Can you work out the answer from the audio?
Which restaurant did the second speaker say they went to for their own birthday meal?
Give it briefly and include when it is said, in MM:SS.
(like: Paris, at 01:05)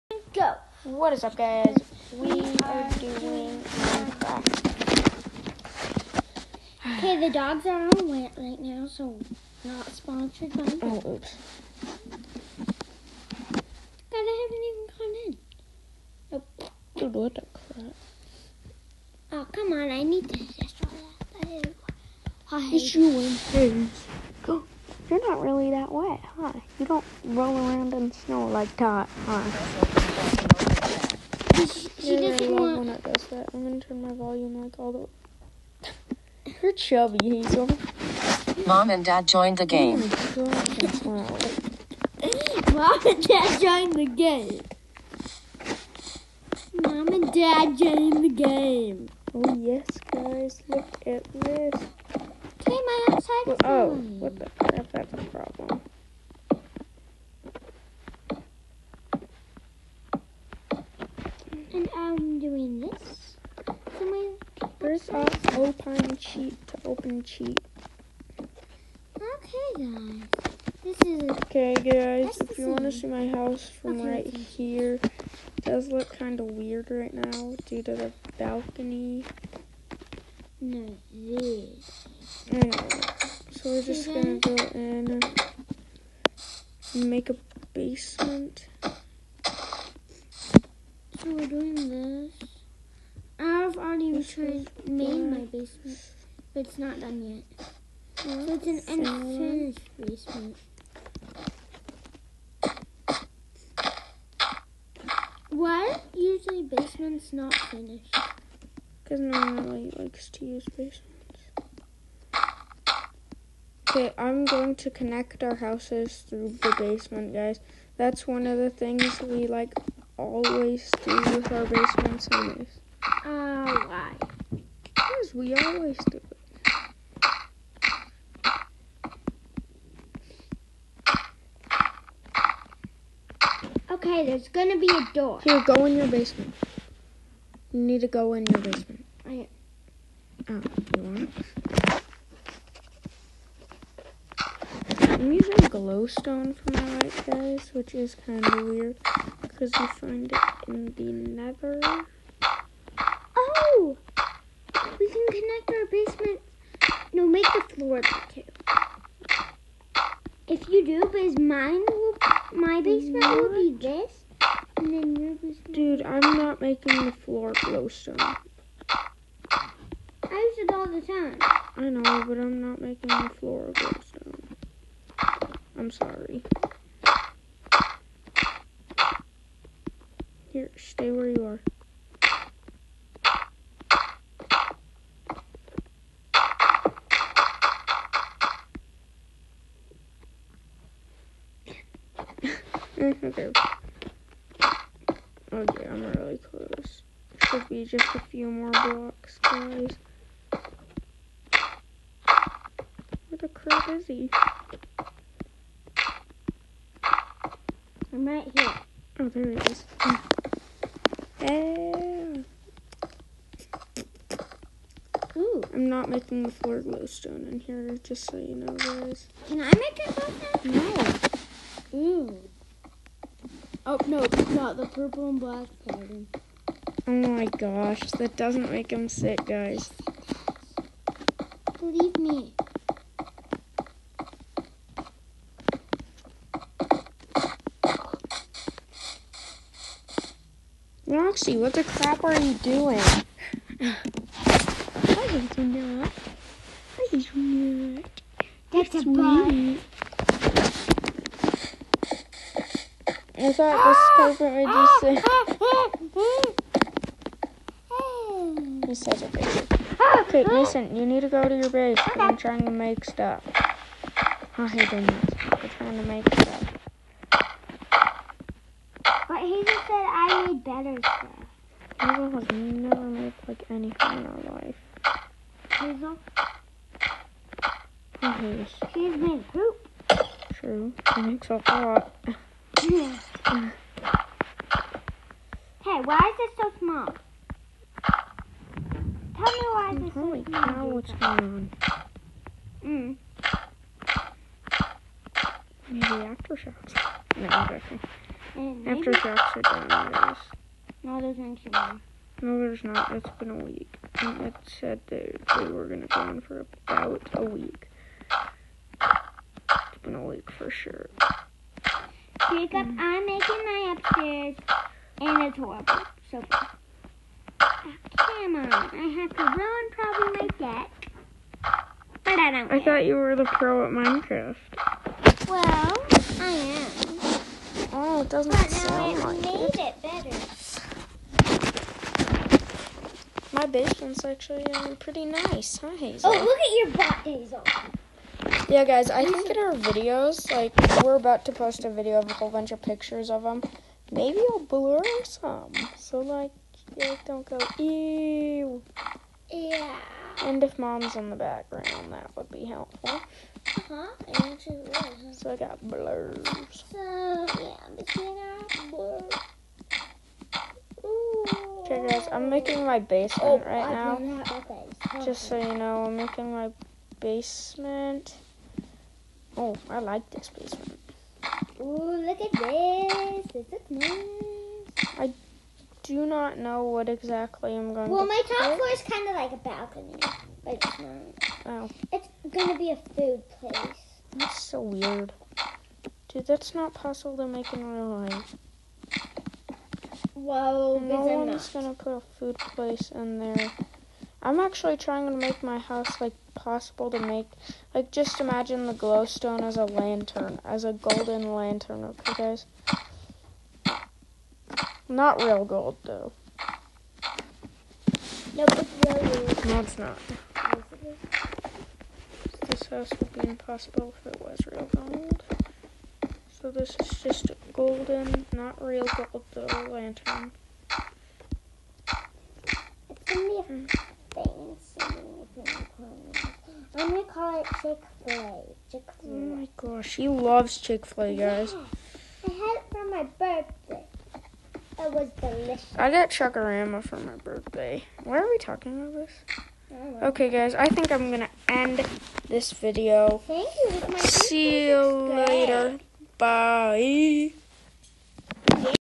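Chuckarama, at 07:16.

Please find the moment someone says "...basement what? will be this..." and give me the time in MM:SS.
02:42.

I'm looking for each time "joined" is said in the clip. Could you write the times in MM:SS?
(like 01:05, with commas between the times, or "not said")
00:39, 00:43, 00:47.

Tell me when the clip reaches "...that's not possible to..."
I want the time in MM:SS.
06:26.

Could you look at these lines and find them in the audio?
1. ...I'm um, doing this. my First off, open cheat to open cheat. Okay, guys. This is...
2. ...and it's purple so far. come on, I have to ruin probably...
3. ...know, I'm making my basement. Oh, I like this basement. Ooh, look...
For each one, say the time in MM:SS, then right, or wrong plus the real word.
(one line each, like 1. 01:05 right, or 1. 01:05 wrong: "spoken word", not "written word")
1. 01:01 right
2. 05:15 wrong: "horrible", not "purple"
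3. 06:05 right.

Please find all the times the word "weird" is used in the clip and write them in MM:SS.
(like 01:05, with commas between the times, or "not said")
01:16, 02:28, 06:24.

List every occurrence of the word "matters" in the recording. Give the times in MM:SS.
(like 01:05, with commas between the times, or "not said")
04:30.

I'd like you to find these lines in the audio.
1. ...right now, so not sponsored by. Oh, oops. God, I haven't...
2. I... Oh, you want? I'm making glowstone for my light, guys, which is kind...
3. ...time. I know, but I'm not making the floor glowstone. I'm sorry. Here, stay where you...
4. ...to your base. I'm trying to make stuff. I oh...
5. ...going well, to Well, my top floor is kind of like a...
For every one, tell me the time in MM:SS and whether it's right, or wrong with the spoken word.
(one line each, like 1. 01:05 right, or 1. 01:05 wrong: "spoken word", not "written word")
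1. 00:08 right
2. 02:19 wrong: "using", not "making"
3. 02:51 right
4. 04:21 right
5. 06:17 right.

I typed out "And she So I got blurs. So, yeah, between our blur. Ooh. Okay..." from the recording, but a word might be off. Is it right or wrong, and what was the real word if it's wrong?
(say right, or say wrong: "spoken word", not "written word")
right.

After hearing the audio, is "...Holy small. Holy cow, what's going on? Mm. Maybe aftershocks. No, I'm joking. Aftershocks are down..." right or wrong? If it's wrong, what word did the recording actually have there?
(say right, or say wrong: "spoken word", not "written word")
right.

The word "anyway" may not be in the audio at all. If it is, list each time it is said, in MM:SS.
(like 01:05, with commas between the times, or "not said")
01:22, 02:02.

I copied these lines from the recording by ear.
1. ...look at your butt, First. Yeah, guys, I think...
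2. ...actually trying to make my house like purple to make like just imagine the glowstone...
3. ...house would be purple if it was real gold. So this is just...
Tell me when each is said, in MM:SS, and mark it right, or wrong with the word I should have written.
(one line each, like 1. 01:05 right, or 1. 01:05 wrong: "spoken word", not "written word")
1. 05:36 wrong: "Hazel", not "First"
2. 06:34 wrong: "possible", not "purple"
3. 06:52 wrong: "impossible", not "purple".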